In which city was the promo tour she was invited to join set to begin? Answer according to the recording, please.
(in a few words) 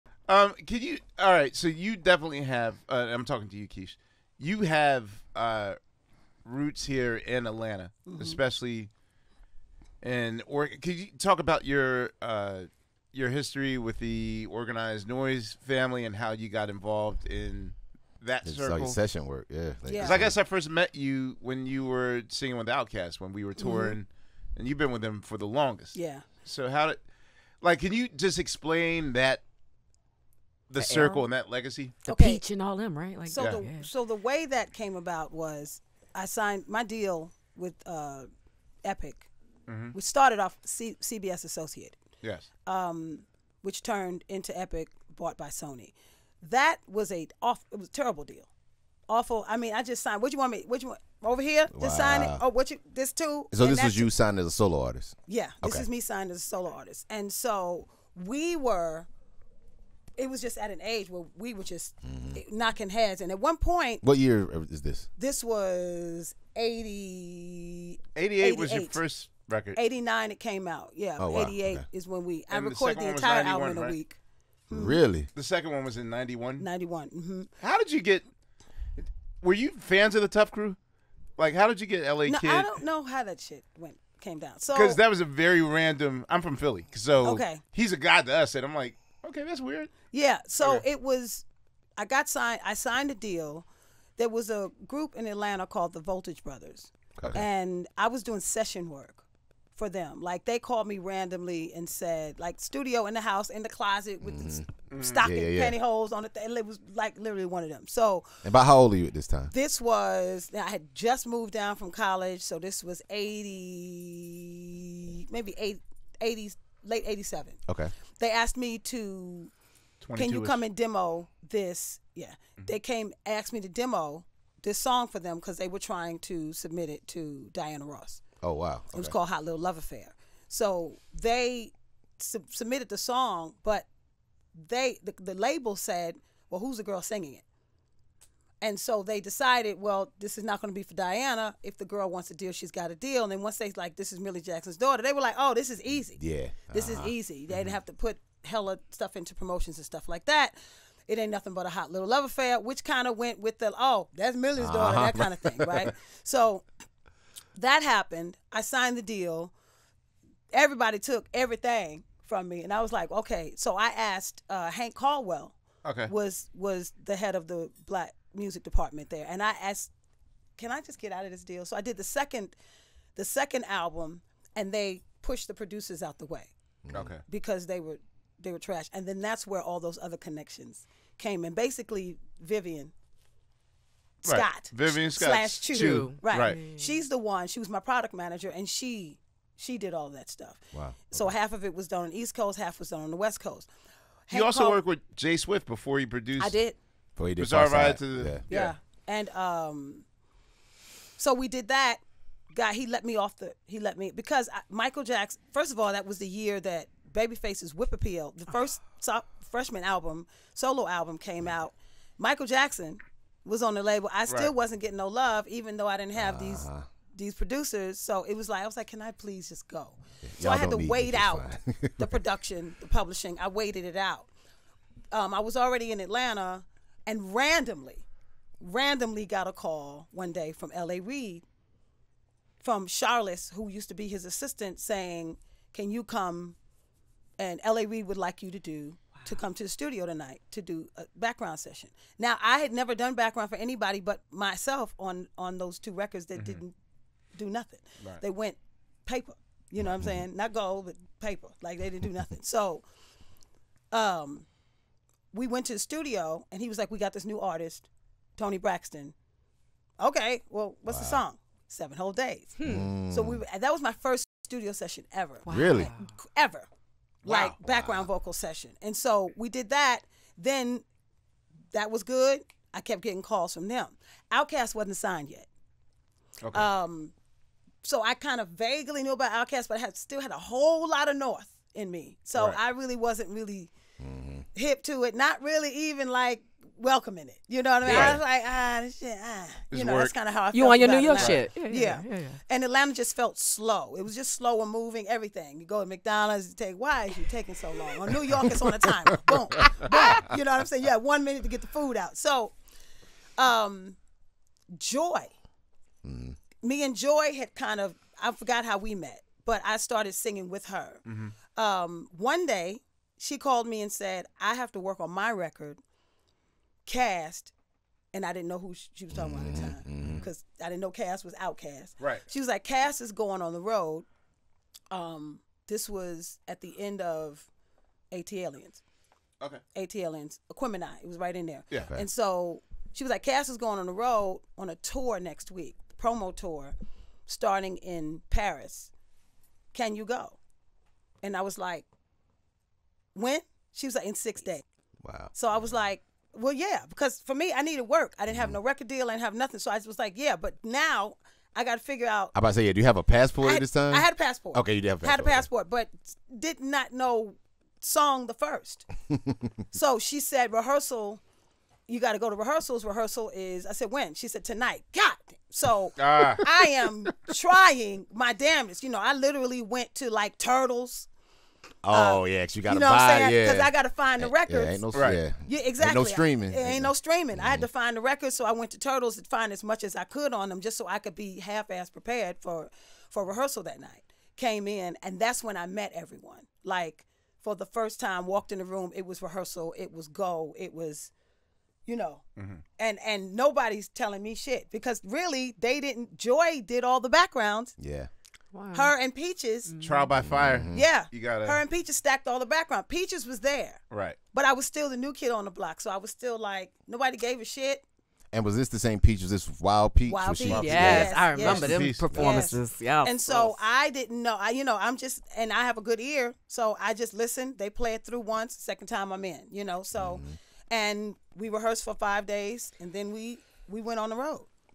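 Paris.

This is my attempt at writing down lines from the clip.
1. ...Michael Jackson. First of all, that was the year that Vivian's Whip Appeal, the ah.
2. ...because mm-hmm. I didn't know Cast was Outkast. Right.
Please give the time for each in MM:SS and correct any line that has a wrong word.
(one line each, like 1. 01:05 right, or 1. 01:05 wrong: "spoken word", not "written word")
1. 03:24 wrong: "Babyface", not "Vivian"
2. 05:20 right.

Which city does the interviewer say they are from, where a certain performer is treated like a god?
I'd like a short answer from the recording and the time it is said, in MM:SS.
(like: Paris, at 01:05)
Philly, at 01:26.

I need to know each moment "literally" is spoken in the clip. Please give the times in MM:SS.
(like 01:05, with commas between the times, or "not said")
01:47, 06:09.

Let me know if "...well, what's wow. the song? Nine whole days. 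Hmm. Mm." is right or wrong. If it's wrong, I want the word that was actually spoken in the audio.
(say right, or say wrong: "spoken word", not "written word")
wrong: "Seven", not "Nine".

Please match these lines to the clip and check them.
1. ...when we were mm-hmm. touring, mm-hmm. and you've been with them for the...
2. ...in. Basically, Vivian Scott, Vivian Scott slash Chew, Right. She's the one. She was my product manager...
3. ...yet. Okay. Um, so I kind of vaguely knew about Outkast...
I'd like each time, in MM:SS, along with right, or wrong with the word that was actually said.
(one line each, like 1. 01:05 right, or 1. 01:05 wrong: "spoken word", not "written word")
1. 00:23 right
2. 03:01 right
3. 04:35 right.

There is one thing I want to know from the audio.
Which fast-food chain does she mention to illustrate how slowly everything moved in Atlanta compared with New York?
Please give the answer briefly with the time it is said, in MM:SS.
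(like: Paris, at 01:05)
McDonald's, at 04:55.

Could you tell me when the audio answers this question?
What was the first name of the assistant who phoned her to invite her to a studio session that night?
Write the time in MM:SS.
03:52.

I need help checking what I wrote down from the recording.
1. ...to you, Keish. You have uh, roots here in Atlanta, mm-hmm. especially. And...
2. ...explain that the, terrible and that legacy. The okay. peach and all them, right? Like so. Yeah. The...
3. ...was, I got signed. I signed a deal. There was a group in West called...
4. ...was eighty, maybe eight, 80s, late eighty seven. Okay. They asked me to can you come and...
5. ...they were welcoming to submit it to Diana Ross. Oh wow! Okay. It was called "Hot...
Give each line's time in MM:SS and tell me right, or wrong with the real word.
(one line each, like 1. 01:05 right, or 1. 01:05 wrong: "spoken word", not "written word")
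1. 00:03 right
2. 00:28 wrong: "circle", not "terrible"
3. 01:31 wrong: "Atlanta", not "West"
4. 01:52 right
5. 02:05 wrong: "trying", not "welcoming".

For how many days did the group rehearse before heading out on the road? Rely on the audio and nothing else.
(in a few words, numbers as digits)
5 days.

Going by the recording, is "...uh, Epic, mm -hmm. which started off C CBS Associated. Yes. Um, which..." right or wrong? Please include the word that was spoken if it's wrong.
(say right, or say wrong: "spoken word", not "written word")
right.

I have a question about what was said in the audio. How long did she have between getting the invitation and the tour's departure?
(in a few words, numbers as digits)
6 days.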